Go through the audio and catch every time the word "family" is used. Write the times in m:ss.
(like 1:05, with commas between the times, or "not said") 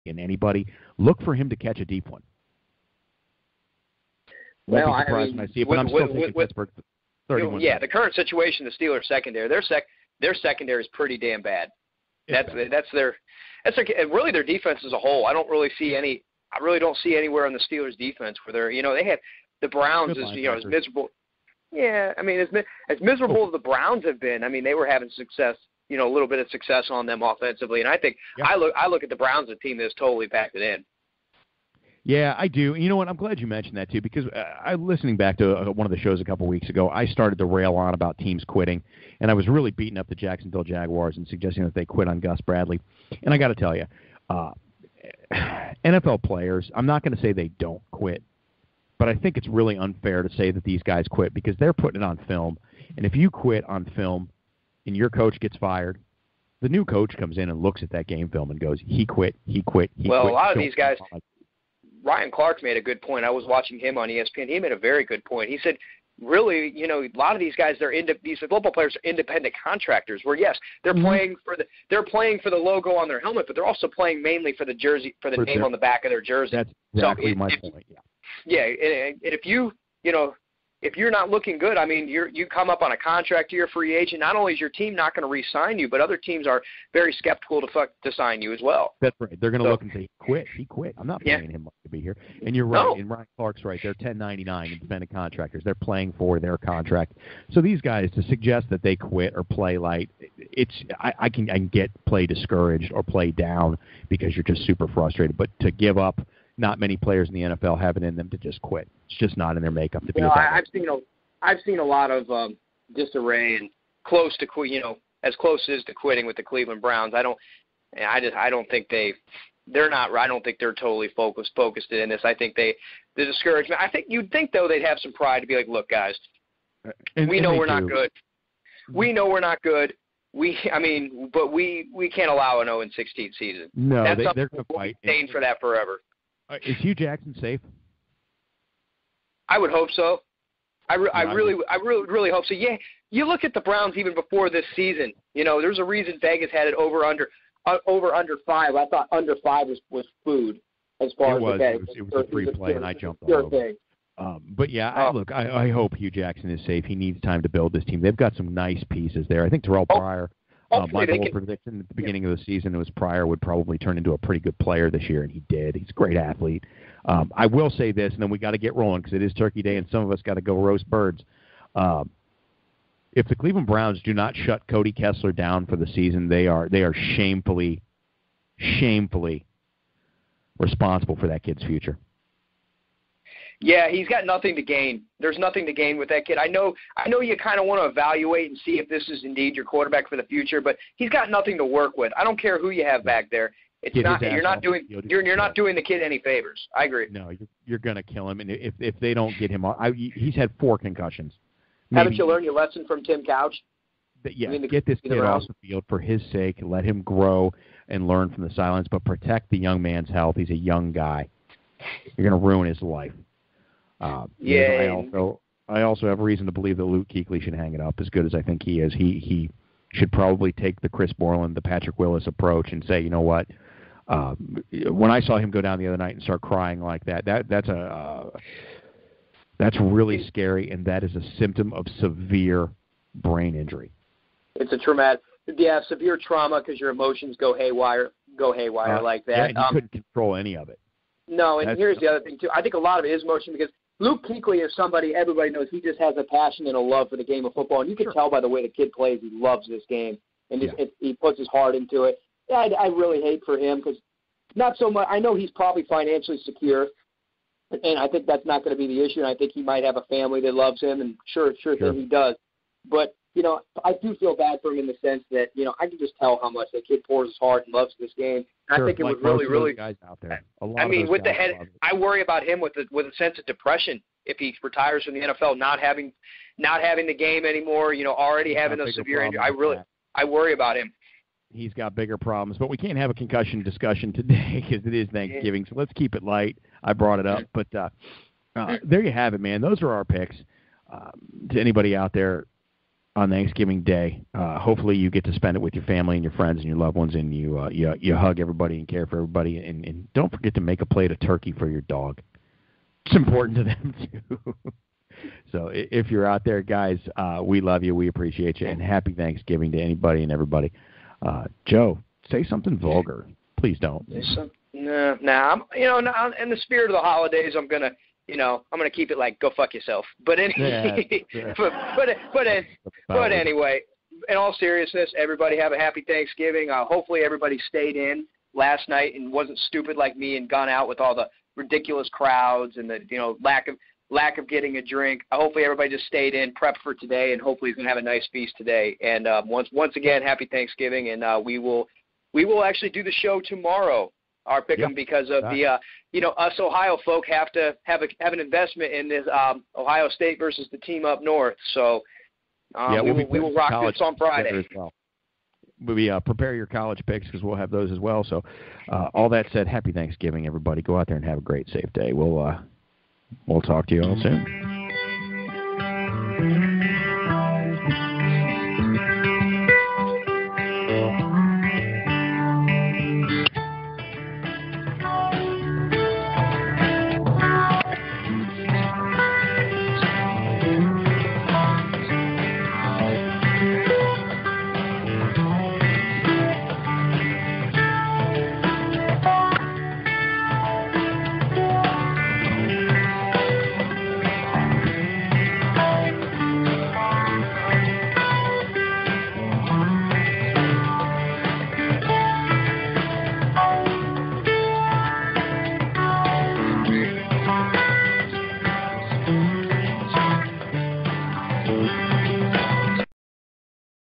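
4:20, 4:55.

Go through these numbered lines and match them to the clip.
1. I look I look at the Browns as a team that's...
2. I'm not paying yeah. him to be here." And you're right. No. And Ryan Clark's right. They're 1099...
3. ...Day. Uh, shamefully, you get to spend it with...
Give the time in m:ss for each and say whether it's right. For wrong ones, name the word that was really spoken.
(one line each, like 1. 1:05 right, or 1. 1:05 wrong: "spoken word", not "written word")
1. 0:28 right
2. 1:30 right
3. 4:53 wrong: "hopefully", not "shamefully".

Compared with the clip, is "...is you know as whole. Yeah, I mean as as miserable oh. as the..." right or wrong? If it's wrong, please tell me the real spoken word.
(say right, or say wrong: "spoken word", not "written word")
wrong: "miserable", not "whole".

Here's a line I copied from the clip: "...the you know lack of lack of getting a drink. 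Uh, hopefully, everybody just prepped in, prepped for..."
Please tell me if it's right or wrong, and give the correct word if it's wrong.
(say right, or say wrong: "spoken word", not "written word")
wrong: "stayed", not "prepped".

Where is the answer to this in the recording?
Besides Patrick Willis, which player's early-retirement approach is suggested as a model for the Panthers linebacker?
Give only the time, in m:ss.
3:40.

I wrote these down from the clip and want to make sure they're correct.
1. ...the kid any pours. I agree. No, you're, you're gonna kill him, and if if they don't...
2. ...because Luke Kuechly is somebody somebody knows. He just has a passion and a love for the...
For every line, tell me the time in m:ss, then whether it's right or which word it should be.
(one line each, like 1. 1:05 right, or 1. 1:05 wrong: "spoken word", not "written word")
1. 3:15 wrong: "favors", not "pours"
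2. 4:03 wrong: "everybody", not "somebody".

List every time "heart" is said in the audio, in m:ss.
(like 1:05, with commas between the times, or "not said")
4:11, 4:27.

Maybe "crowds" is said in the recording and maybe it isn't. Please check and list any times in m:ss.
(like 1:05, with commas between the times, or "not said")
5:32.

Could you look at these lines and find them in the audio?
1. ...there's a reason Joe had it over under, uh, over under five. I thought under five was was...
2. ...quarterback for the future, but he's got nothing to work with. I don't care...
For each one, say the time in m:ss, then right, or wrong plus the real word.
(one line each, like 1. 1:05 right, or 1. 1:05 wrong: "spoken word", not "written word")
1. 2:25 wrong: "Vegas", not "Joe"
2. 3:09 right.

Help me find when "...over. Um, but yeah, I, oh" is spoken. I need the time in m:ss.
2:33.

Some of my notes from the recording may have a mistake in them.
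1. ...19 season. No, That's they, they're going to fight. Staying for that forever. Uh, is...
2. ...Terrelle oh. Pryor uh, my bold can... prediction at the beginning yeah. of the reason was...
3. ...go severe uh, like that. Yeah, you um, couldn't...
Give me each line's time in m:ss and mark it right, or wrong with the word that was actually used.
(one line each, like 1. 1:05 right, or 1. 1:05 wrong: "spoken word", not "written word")
1. 2:12 wrong: "16", not "19"
2. 2:39 wrong: "season", not "reason"
3. 3:58 wrong: "haywire", not "severe".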